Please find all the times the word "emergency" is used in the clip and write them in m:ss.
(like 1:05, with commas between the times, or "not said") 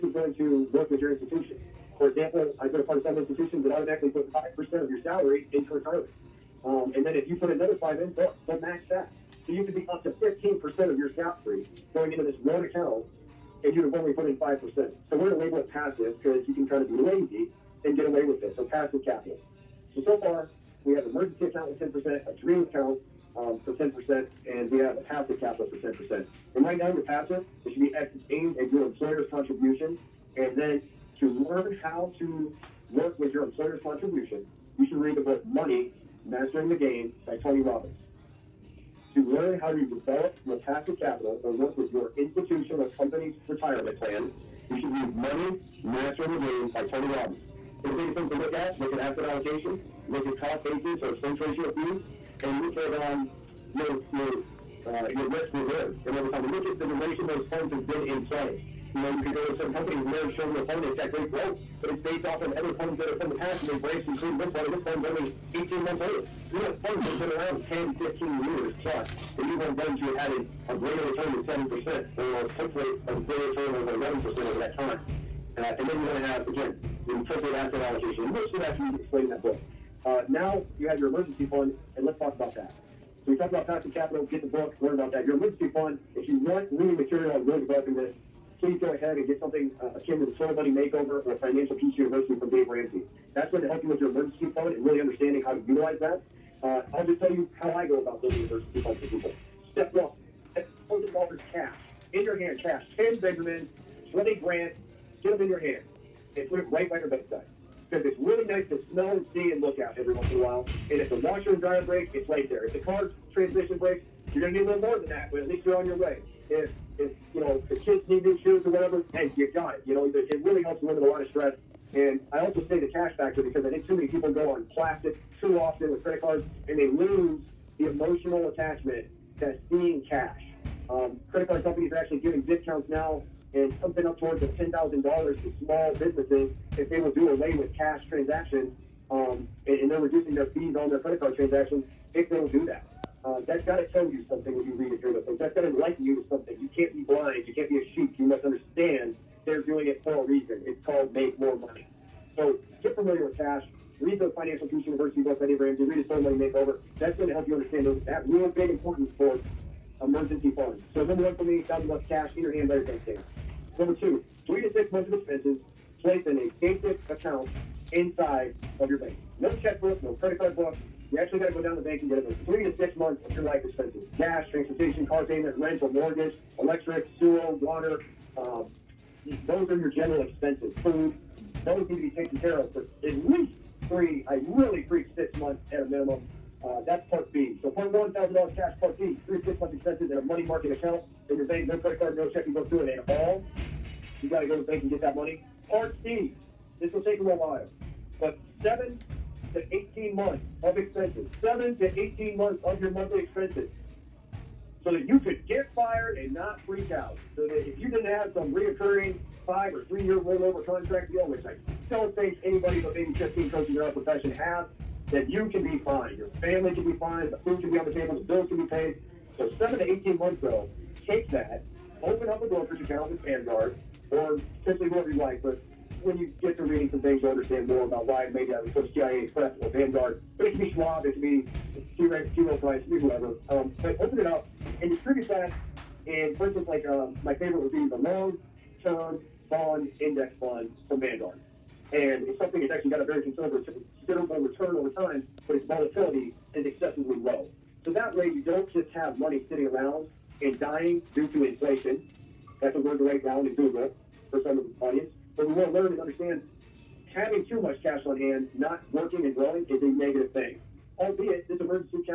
0:21, 1:21, 1:25, 1:34, 2:40, 4:21.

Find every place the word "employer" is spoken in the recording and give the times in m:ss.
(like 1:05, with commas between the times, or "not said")
0:28, 0:33.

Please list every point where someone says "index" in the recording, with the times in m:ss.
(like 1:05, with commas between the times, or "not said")
4:00.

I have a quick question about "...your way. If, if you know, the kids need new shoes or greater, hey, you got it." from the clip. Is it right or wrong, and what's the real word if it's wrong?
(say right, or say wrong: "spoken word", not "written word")
wrong: "whatever", not "greater".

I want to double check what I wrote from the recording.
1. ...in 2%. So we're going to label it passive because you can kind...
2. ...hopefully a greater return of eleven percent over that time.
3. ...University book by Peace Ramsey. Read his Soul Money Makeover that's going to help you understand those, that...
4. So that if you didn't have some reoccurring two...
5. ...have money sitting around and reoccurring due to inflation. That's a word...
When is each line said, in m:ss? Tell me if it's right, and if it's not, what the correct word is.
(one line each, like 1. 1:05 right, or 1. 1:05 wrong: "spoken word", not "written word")
1. 0:14 wrong: "5", not "2"
2. 1:12 right
3. 2:34 wrong: "Dave", not "Peace"
4. 3:27 wrong: "five", not "two"
5. 4:08 wrong: "dying", not "reoccurring".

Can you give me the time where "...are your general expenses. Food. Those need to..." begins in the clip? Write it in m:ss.
2:59.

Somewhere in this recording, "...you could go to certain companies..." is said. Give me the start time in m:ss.
0:59.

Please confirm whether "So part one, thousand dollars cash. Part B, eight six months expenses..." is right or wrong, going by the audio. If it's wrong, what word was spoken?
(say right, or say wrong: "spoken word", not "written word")
wrong: "three", not "eight".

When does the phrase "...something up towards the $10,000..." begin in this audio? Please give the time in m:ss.
2:13.